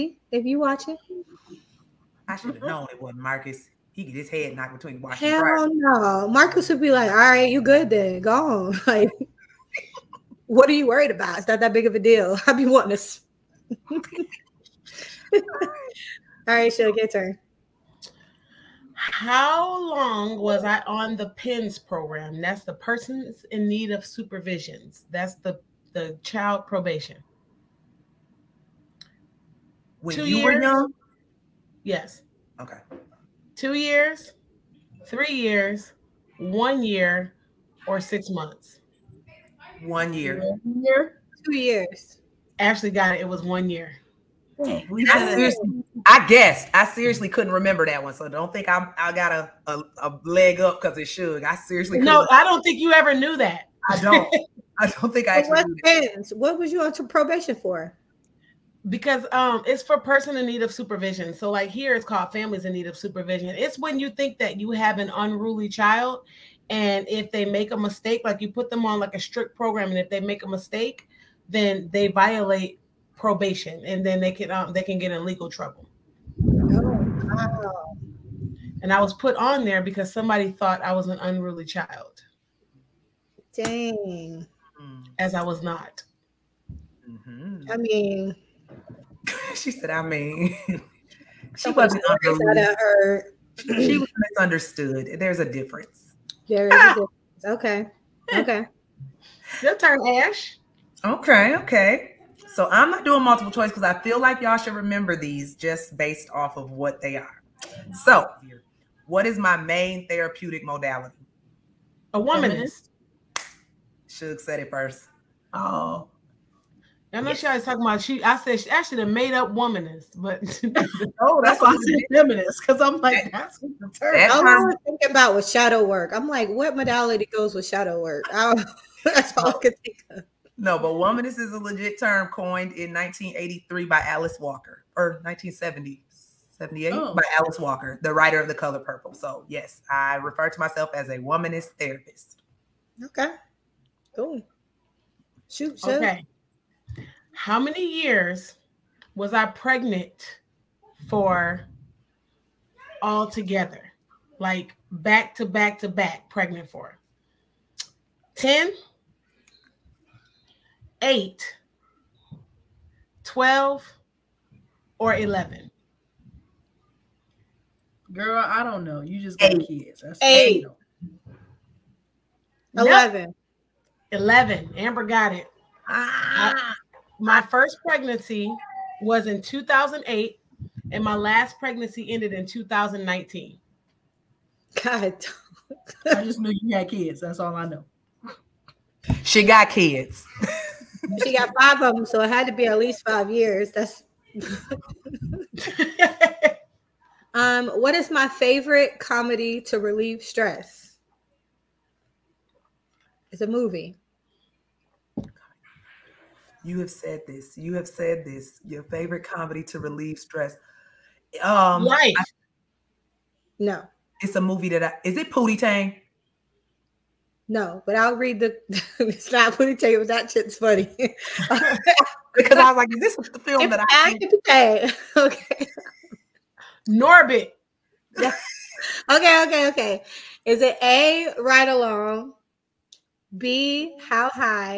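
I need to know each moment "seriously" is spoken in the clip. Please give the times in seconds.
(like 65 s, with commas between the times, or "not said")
46 s, 51 s.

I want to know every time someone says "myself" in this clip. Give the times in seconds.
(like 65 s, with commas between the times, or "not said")
140 s.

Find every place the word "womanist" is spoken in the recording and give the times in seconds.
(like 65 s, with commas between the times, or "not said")
112 s, 119 s, 130 s, 141 s.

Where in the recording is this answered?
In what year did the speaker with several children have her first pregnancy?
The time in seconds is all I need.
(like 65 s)
179 s.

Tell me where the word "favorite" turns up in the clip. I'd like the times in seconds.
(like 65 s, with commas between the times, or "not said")
198 s, 208 s.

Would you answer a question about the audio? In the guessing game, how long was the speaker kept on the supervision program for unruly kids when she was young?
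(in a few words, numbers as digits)
1 year.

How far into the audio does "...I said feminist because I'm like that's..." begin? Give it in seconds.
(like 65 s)
121 s.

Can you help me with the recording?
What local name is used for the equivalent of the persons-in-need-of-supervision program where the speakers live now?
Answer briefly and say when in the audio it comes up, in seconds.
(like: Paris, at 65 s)
families in need of supervision, at 62 s.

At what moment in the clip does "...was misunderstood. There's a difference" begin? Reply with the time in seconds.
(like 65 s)
93 s.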